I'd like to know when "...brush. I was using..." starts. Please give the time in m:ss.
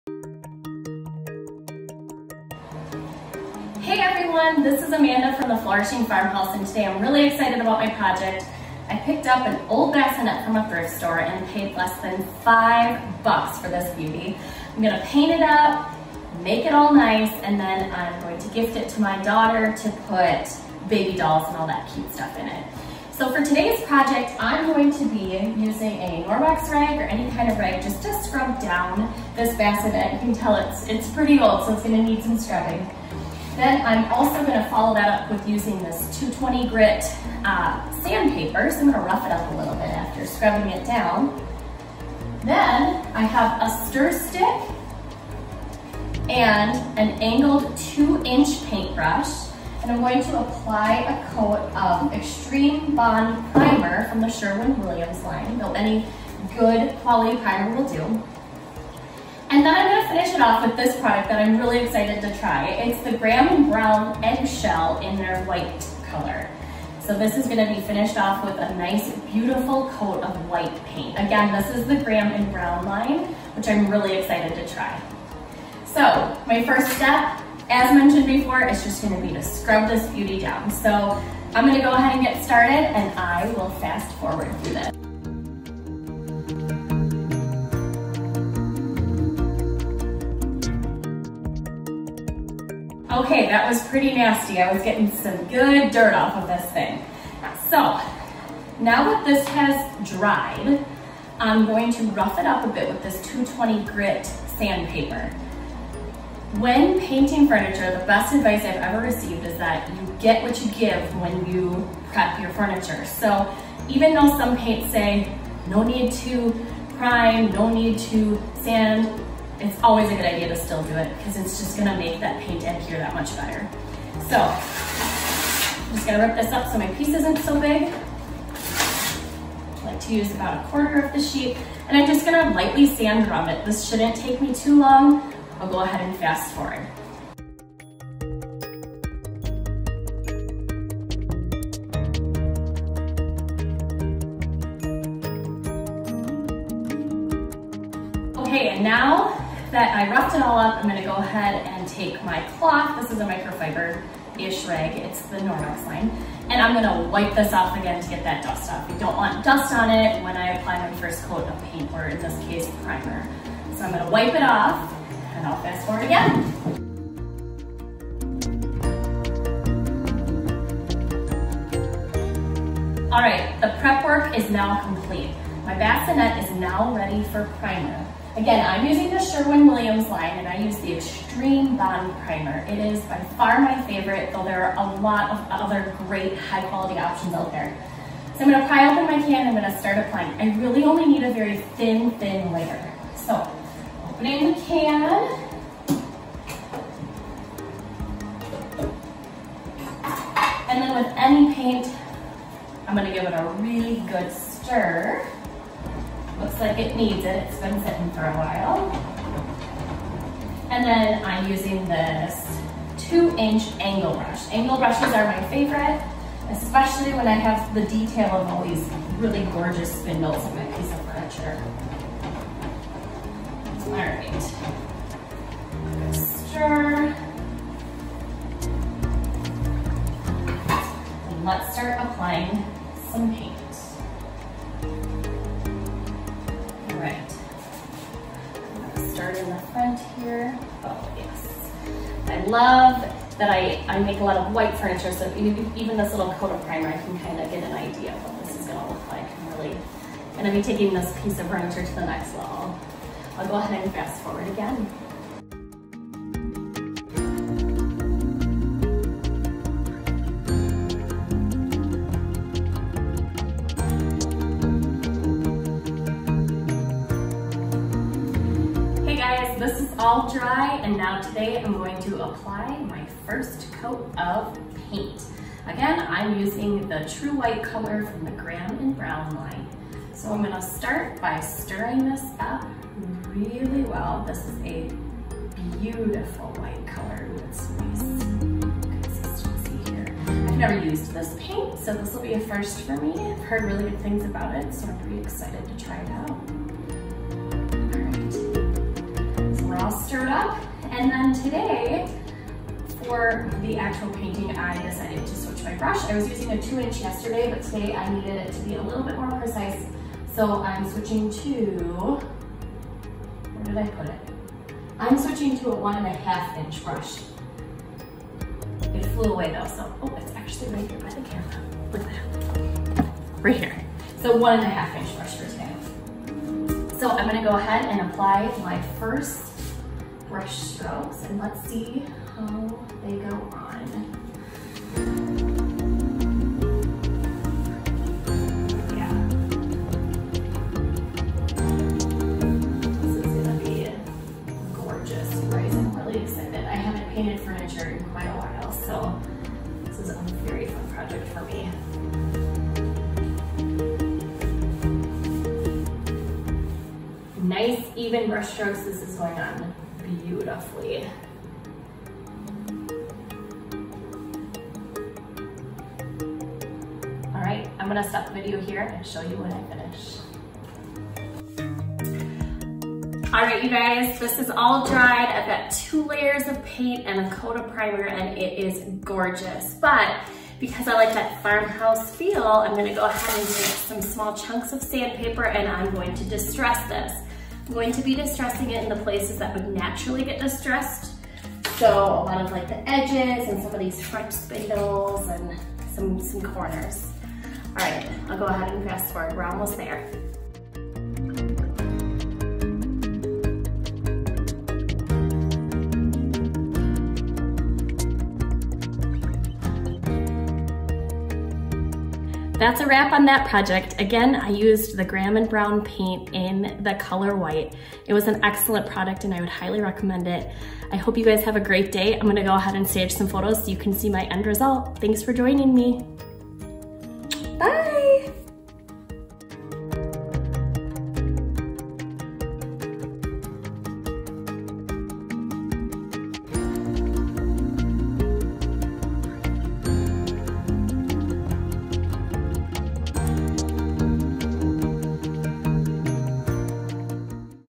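5:05.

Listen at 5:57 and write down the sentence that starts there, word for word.
Nice even brush strokes this is going on.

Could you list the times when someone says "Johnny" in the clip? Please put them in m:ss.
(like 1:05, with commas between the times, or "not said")
not said.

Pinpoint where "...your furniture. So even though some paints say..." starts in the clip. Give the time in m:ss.
1:52.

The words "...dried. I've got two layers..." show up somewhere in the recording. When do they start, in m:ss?
6:14.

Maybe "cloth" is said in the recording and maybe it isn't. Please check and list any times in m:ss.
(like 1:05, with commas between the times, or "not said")
2:32.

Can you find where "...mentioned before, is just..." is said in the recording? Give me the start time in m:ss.
1:17.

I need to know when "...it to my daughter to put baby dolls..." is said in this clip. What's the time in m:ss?
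0:18.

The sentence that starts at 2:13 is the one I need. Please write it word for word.
This shouldn't take me too long.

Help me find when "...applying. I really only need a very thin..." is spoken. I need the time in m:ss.
3:09.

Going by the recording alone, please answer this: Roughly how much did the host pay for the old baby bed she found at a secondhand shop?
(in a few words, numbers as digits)
less than 5 dollars.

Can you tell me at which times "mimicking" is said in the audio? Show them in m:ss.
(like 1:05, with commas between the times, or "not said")
not said.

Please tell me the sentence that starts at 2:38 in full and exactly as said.
You don't want dust on it when I apply my first coat of paint, or in this case, primer.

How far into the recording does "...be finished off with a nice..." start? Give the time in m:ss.
1:07.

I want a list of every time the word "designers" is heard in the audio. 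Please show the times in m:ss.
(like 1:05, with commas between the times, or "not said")
not said.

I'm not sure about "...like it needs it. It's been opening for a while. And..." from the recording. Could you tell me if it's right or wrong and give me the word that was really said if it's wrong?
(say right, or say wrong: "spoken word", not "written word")
wrong: "sitting", not "opening".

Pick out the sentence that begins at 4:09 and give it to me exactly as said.
I'm really gonna be taking this piece of furniture to the next level.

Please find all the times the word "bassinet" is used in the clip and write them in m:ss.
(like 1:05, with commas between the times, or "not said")
0:09, 0:29, 2:55.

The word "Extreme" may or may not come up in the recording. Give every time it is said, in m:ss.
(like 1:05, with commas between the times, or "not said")
0:52, 3:00.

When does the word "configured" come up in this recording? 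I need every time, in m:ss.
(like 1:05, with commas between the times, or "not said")
not said.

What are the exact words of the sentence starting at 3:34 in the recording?
Angle brushes are my favorite, especially when I have the detail of all these really gorgeous spindles in my piece of furniture.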